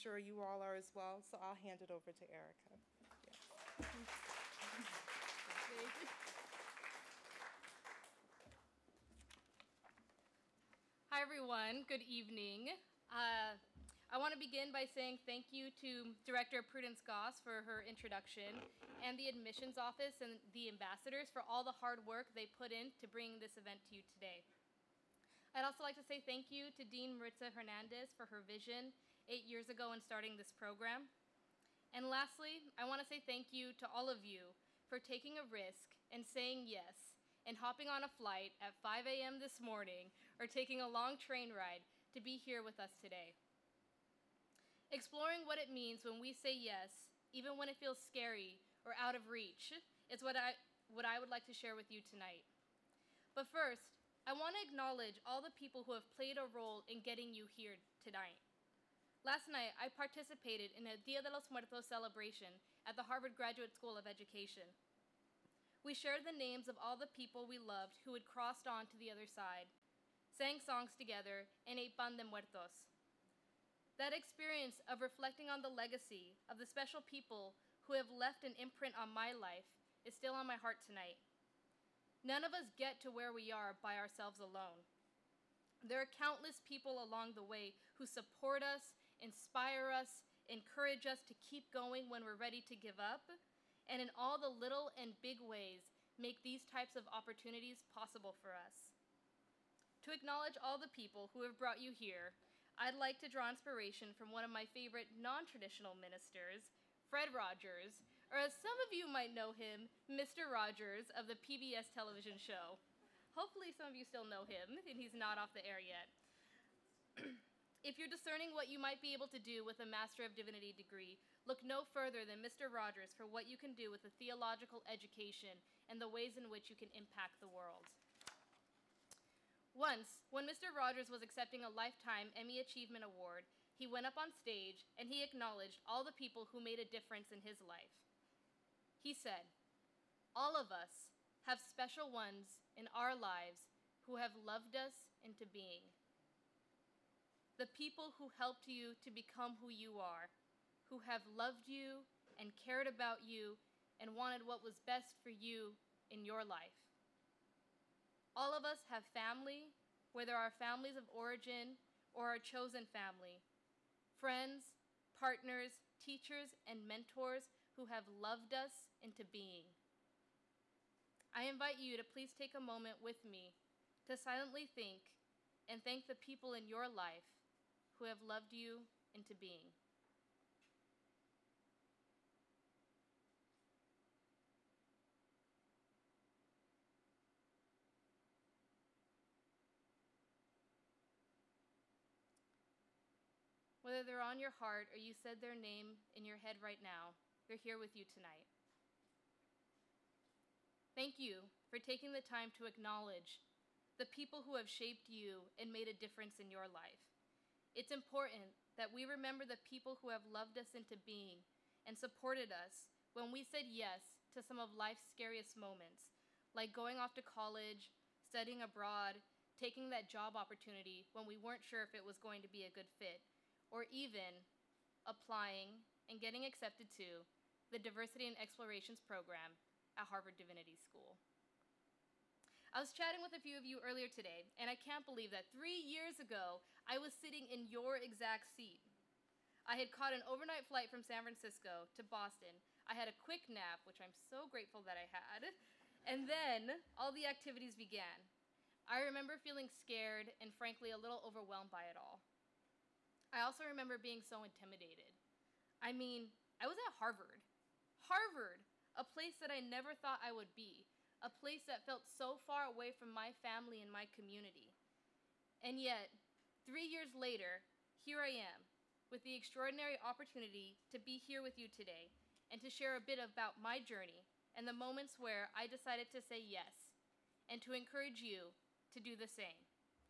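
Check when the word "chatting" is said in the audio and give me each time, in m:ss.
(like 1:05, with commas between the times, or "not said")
3:52.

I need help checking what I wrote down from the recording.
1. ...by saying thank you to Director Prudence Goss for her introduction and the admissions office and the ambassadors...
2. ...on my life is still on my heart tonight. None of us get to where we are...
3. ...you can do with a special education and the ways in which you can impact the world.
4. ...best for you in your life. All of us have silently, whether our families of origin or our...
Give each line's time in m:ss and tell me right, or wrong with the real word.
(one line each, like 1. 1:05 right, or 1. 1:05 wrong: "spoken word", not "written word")
1. 0:14 right
2. 1:18 right
3. 2:03 wrong: "theological", not "special"
4. 2:34 wrong: "family", not "silently".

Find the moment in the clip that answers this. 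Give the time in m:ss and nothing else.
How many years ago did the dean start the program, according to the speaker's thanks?
0:29.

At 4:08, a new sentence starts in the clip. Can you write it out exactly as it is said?
I remember feeling scared and frankly a little overwhelmed by it all.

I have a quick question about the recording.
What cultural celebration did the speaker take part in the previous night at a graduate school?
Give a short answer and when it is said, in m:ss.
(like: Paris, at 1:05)
Dia de los Muertos, at 1:00.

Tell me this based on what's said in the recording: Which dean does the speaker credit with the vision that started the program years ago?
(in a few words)
Maritza Hernandez.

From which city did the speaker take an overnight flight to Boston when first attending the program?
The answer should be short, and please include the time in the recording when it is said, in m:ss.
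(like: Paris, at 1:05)
San Francisco, at 4:01.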